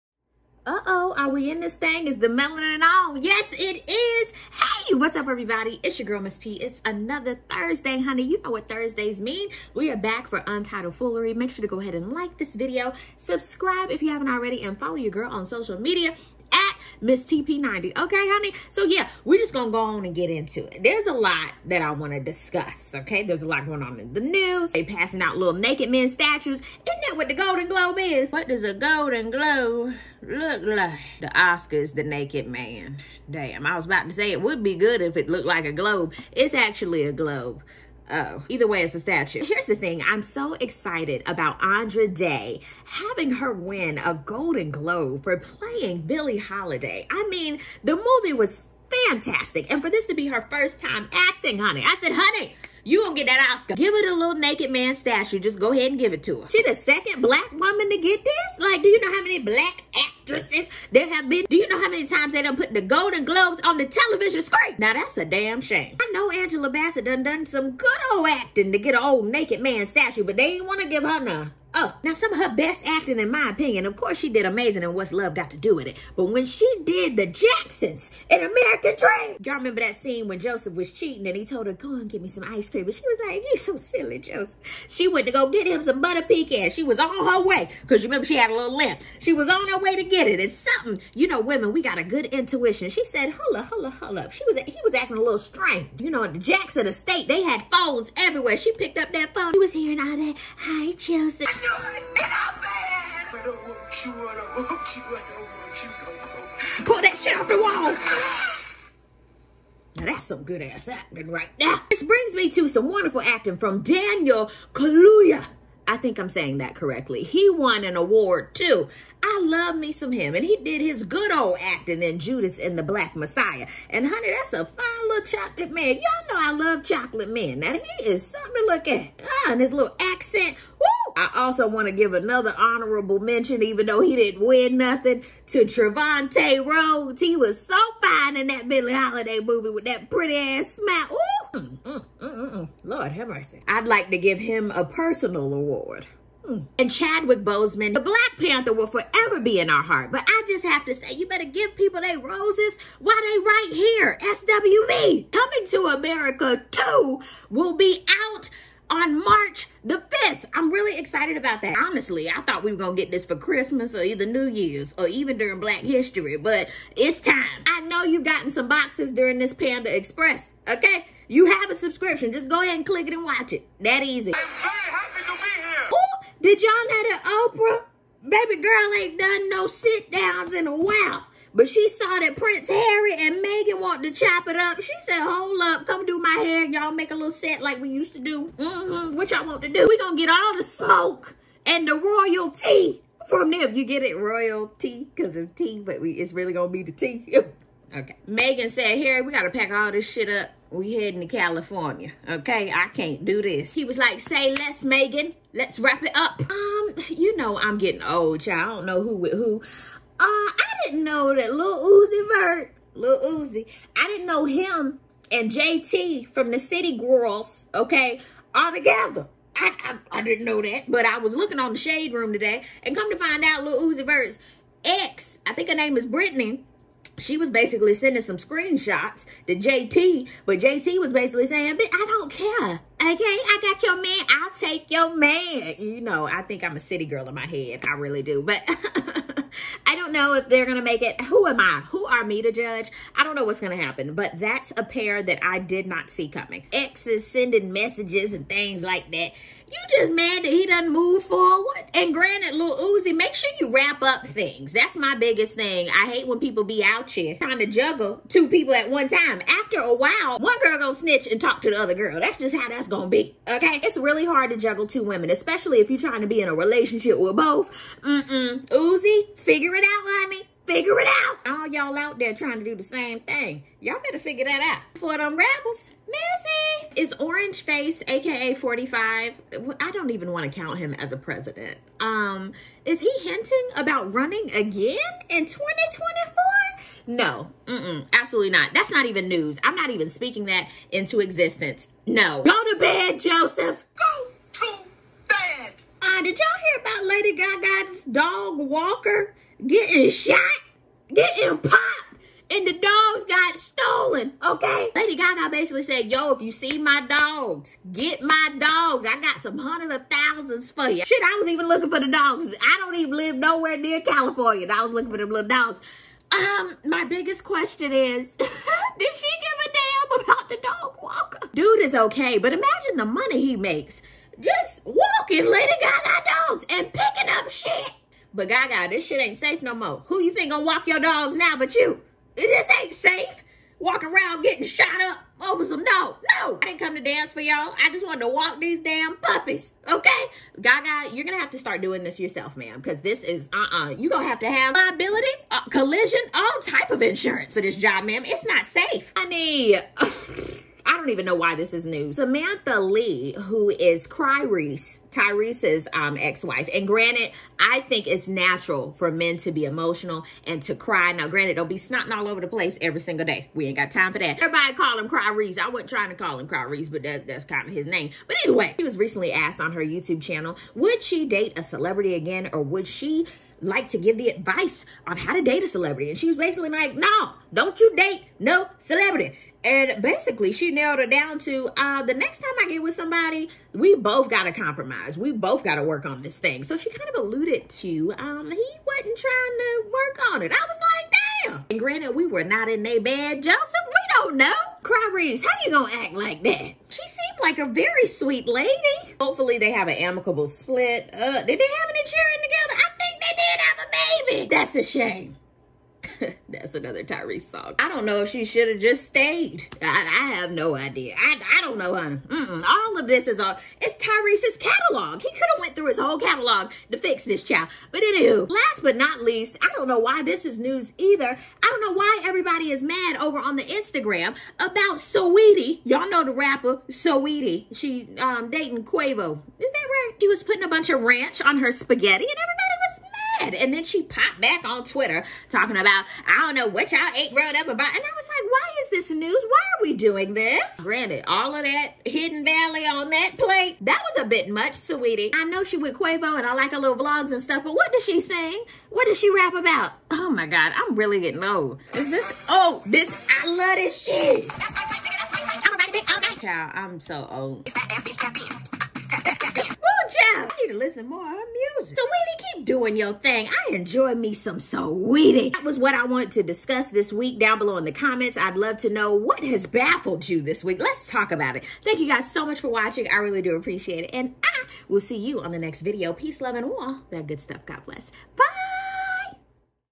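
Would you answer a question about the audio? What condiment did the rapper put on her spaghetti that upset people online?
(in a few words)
ranch.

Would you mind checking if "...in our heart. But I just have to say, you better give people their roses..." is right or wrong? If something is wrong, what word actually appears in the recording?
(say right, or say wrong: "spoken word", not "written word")
right.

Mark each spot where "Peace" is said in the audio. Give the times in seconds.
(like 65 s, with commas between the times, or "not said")
476 s.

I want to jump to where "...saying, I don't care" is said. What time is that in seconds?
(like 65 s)
231 s.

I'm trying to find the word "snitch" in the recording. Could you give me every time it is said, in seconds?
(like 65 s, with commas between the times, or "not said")
260 s.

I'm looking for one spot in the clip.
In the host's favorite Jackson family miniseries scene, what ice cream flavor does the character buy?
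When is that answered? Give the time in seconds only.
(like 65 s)
86 s.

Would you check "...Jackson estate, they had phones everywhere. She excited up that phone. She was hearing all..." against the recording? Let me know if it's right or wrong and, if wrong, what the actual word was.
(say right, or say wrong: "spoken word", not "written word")
wrong: "picked", not "excited".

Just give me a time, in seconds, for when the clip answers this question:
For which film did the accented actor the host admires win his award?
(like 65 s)
122 s.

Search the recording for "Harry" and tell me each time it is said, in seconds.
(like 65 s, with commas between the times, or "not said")
182 s, 199 s.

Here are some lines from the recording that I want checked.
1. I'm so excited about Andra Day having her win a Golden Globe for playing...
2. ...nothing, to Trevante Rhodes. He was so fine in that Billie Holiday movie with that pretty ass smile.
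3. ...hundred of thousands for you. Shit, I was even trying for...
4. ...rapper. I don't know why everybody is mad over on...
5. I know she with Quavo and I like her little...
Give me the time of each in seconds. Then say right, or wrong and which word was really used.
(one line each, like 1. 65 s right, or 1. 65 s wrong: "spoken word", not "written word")
1. 40 s right
2. 134 s right
3. 309 s wrong: "looking", not "trying"
4. 421 s wrong: "either", not "rapper"
5. 445 s right.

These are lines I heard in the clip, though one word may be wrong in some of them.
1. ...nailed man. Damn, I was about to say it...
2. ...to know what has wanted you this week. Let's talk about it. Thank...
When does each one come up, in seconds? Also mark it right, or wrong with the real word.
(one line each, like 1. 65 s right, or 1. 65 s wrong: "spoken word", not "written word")
1. 32 s wrong: "naked", not "nailed"
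2. 468 s wrong: "baffled", not "wanted".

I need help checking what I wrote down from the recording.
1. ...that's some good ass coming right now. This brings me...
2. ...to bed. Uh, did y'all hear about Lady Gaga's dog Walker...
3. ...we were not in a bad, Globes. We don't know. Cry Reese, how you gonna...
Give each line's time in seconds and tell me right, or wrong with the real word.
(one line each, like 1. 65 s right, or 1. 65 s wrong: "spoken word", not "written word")
1. 110 s wrong: "acting", not "coming"
2. 294 s right
3. 392 s wrong: "Joseph", not "Globes".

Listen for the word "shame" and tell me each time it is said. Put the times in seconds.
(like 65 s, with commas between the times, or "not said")
65 s, 404 s.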